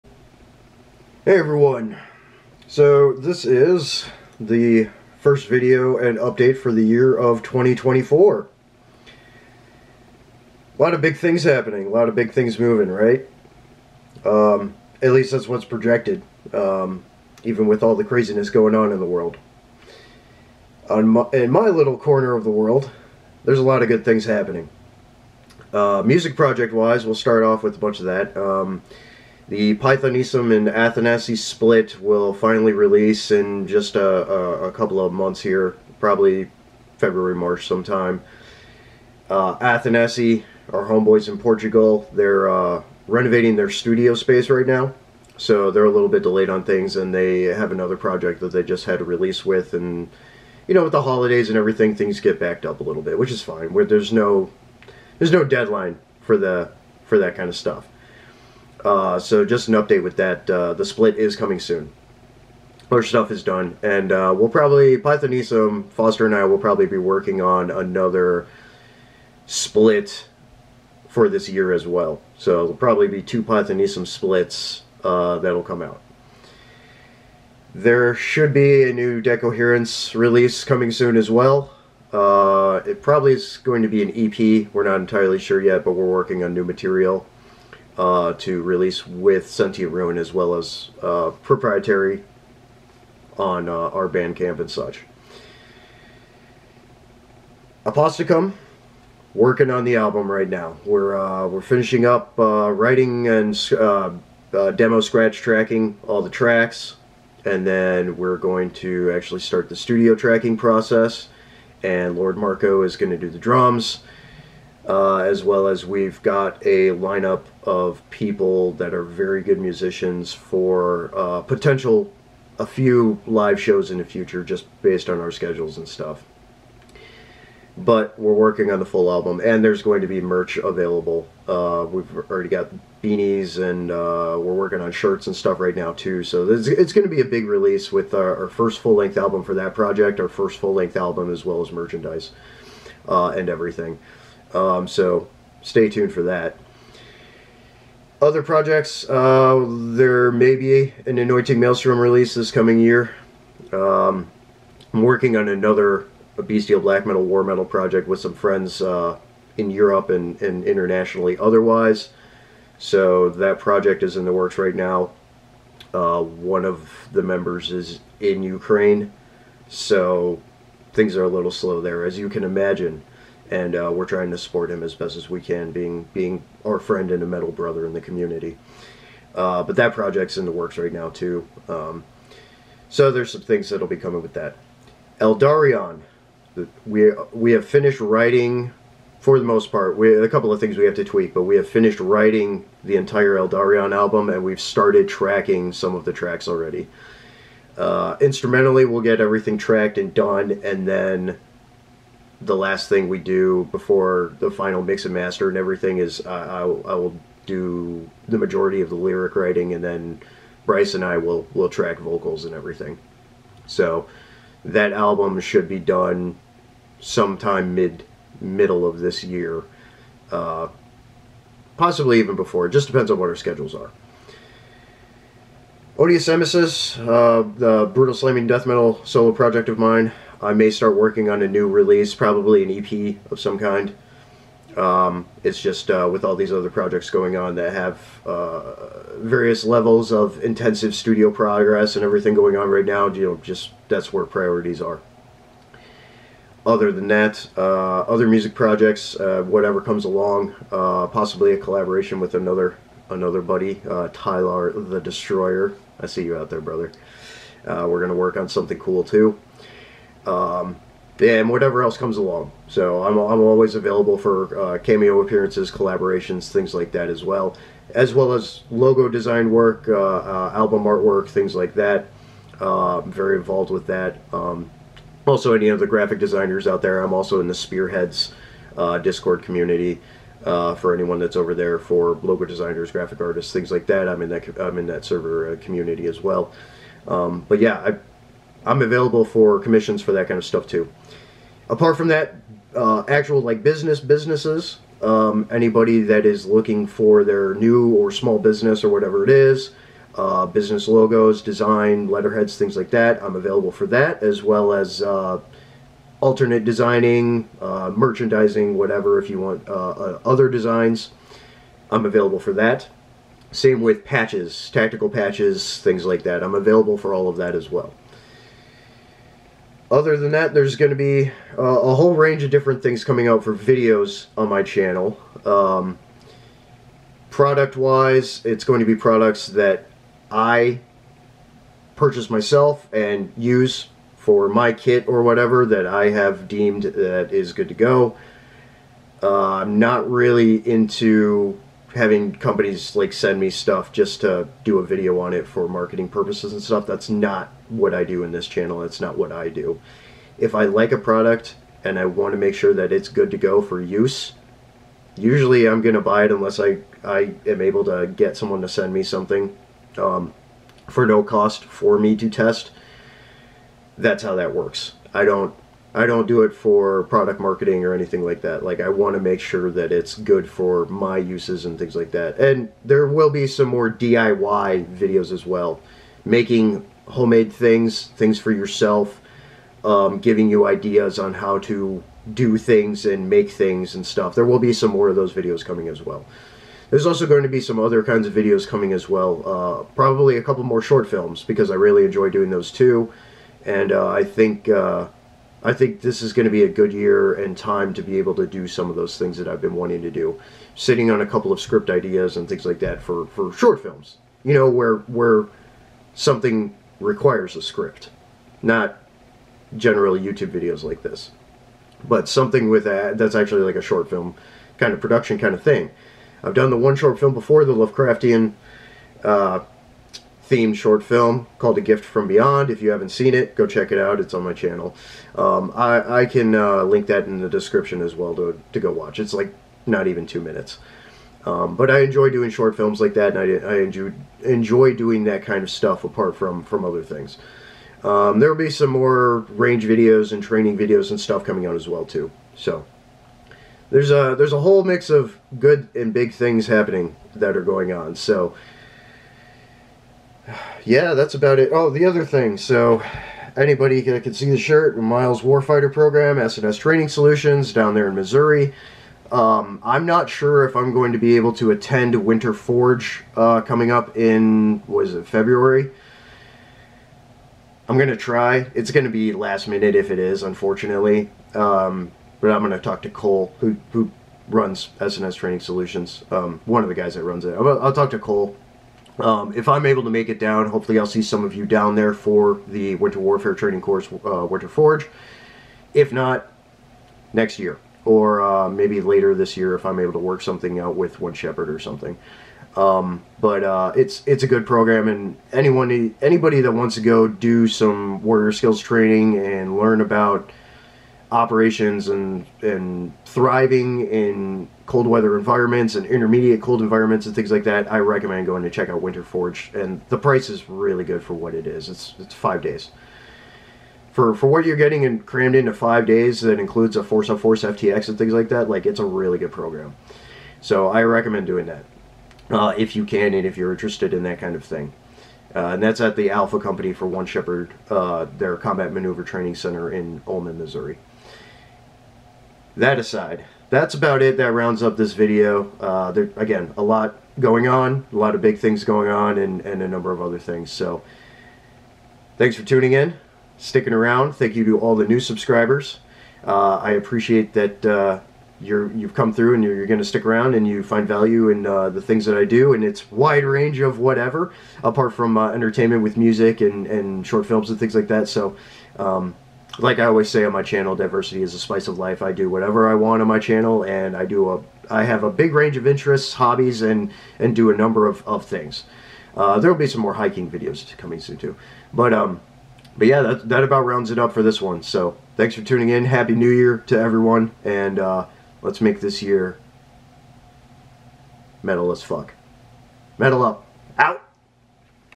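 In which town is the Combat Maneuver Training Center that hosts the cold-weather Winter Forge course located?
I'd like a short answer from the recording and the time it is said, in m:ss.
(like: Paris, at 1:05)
Ulman, Missouri, at 8:50.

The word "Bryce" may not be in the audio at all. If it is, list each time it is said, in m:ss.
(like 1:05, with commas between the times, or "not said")
3:30.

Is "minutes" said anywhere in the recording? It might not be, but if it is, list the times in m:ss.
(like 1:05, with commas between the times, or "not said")
7:10, 7:49.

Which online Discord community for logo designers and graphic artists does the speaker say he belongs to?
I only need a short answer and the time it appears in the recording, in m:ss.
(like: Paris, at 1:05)
Spearheads, at 4:37.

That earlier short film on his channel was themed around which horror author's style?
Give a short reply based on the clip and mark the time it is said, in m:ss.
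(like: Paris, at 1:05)
Lovecraftian, at 6:57.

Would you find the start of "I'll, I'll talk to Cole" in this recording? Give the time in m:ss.
7:57.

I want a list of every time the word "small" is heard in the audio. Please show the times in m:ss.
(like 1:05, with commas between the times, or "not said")
4:58.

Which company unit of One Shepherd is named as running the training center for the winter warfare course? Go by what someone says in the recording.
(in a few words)
Alpha Company.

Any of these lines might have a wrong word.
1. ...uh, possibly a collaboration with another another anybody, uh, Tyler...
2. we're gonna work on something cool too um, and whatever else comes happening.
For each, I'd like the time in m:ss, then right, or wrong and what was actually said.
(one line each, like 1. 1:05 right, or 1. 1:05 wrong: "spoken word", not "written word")
1. 4:10 wrong: "buddy", not "anybody"
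2. 4:17 wrong: "along", not "happening".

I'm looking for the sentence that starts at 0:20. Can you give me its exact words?
On my, in my little corner of the world, there's a lot of good things happening.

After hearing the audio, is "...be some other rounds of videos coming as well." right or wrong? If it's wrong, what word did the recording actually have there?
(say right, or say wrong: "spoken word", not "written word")
wrong: "kinds", not "rounds".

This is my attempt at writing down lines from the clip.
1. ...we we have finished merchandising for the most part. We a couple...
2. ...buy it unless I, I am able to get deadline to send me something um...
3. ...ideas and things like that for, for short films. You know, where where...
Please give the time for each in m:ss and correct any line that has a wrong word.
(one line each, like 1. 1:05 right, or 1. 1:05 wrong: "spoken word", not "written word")
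1. 3:06 wrong: "writing", not "merchandising"
2. 5:56 wrong: "someone", not "deadline"
3. 6:41 right.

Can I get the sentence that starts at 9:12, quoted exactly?
And it's wide range of whatever, apart from uh, entertainment with music and, and short films and things like that.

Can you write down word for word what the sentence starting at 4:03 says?
You know, just that's where priorities are.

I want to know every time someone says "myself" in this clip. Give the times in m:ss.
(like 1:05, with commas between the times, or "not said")
5:32.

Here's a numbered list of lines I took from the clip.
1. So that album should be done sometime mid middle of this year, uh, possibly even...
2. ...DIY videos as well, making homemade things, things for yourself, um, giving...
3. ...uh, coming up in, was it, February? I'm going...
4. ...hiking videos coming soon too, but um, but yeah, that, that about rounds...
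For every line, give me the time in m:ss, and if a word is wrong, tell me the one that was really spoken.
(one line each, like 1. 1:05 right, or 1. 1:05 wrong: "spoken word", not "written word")
1. 3:33 right
2. 6:13 right
3. 7:43 right
4. 9:30 right.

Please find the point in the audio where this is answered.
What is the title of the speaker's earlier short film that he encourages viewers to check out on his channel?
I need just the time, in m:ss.
7:01.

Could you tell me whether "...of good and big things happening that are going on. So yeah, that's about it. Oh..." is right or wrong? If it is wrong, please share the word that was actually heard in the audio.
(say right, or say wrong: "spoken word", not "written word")
right.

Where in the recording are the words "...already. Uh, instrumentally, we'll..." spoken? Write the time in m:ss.
3:16.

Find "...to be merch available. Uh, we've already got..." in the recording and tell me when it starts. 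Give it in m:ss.
2:10.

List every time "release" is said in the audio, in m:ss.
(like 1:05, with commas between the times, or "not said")
0:32, 0:49, 1:20, 1:28, 2:17, 2:31, 3:51.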